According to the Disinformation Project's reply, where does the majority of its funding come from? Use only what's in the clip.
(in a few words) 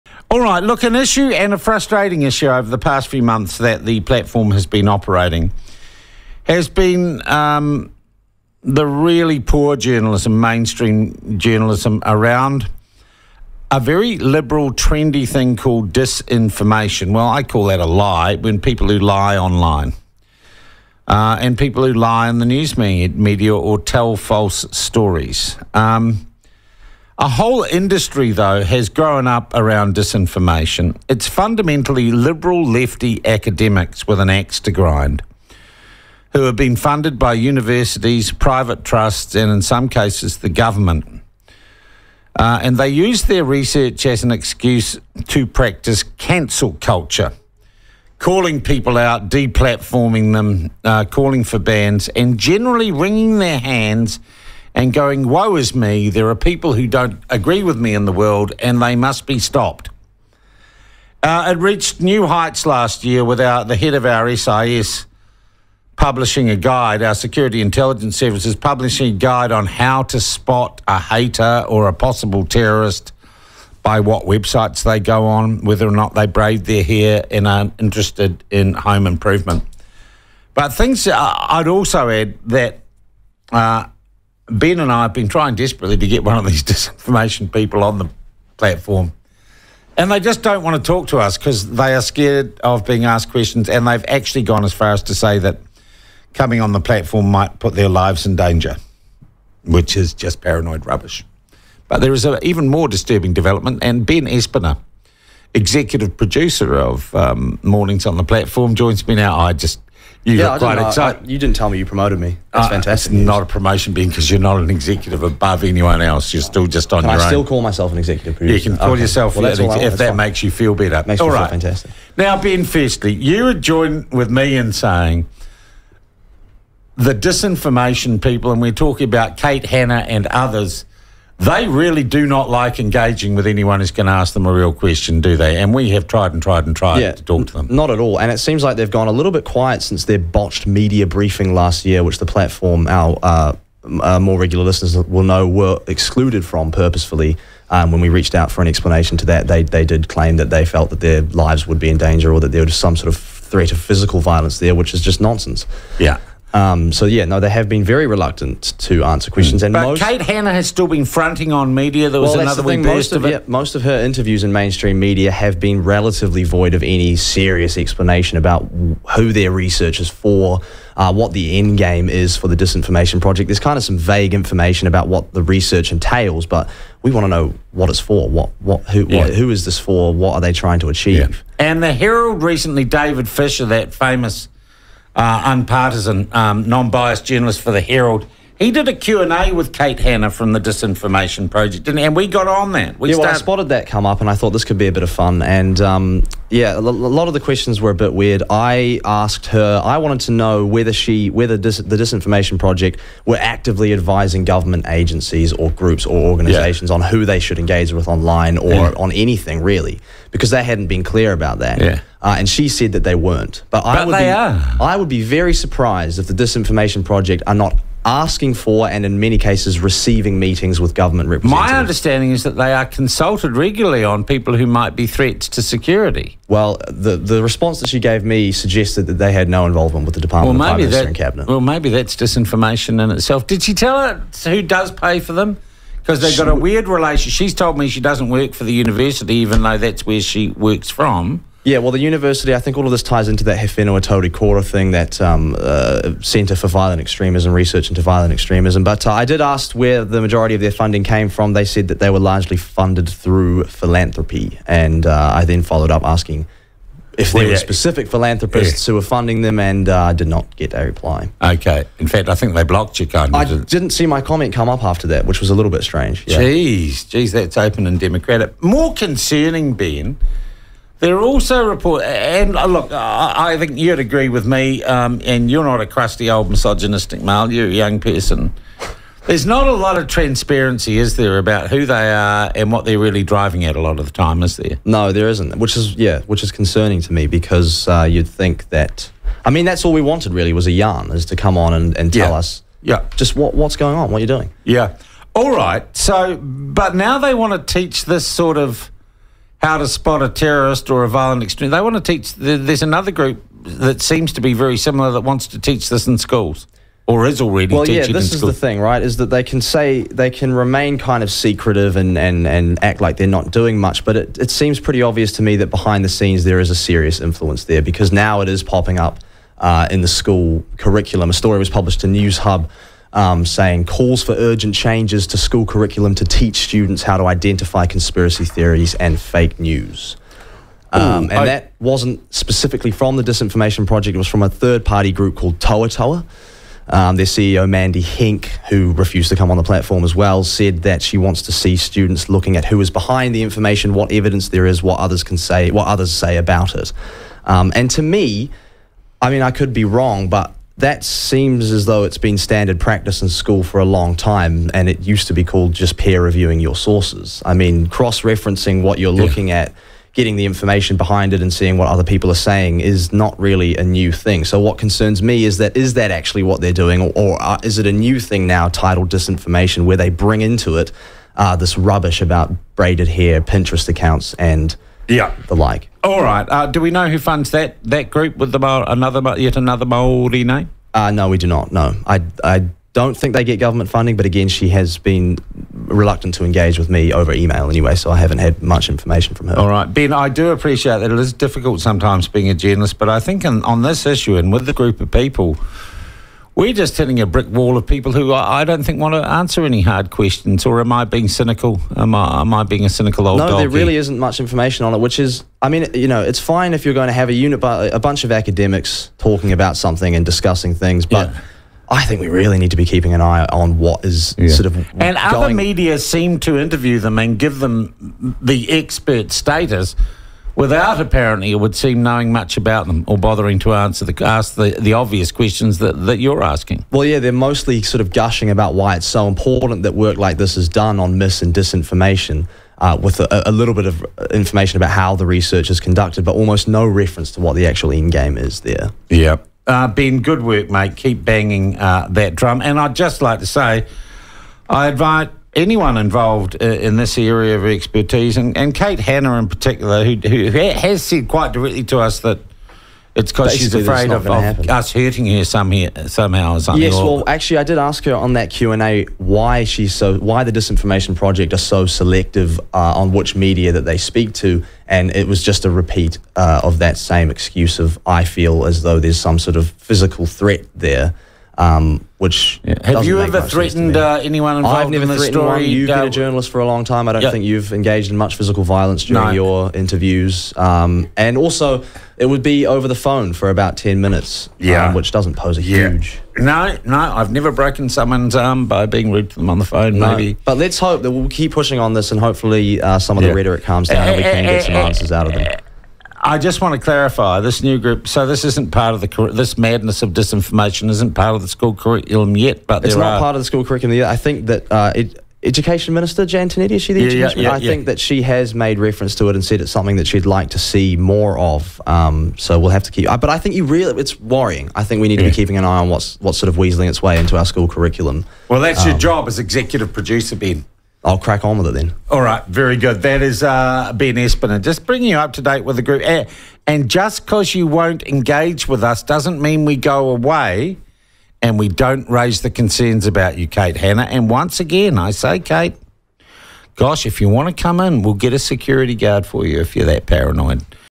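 Philanthropy.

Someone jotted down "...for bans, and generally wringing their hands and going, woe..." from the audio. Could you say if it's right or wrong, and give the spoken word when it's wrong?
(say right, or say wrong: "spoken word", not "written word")
right.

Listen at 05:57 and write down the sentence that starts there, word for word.
I mean, cross referencing what you're yeah.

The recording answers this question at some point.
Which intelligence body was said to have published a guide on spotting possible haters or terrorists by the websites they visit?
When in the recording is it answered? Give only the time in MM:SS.
01:07.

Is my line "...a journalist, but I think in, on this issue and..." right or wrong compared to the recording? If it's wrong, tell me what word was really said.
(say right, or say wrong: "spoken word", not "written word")
right.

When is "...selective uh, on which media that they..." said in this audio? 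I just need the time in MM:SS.
07:41.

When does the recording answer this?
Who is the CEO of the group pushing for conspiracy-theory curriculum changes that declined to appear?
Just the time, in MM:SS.
05:37.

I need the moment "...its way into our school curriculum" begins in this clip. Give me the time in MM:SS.
08:36.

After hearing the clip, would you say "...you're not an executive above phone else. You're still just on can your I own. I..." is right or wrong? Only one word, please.
wrong.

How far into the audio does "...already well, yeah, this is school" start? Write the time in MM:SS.
05:07.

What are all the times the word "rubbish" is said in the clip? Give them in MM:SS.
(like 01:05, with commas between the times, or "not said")
01:40, 06:11.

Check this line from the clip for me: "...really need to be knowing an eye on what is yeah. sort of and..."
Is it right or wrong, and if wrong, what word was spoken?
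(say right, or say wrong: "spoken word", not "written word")
wrong: "keeping", not "knowing".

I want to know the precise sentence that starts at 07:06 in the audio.
Well, yeah, they're mostly sort of gushing about why it's so important that work like this is done on mis and disinformation.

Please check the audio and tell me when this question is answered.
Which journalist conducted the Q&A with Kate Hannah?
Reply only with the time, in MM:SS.
03:02.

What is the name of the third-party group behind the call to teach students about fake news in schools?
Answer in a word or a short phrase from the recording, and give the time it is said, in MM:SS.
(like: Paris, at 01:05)
Tohatoha, at 05:35.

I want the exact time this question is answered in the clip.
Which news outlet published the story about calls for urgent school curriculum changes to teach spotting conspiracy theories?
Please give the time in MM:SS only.
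05:22.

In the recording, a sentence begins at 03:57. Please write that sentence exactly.
She's told me she doesn't work for the university, even though that's where she works from.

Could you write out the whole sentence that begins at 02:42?
There was well, another thing, most of, of it.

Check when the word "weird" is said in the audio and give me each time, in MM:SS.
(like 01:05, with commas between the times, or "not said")
03:18, 03:56.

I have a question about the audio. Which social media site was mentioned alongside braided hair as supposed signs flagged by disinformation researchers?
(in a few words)
Pinterest.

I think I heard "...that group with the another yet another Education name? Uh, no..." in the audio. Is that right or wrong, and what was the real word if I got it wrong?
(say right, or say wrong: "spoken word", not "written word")
wrong: "Maori", not "Education".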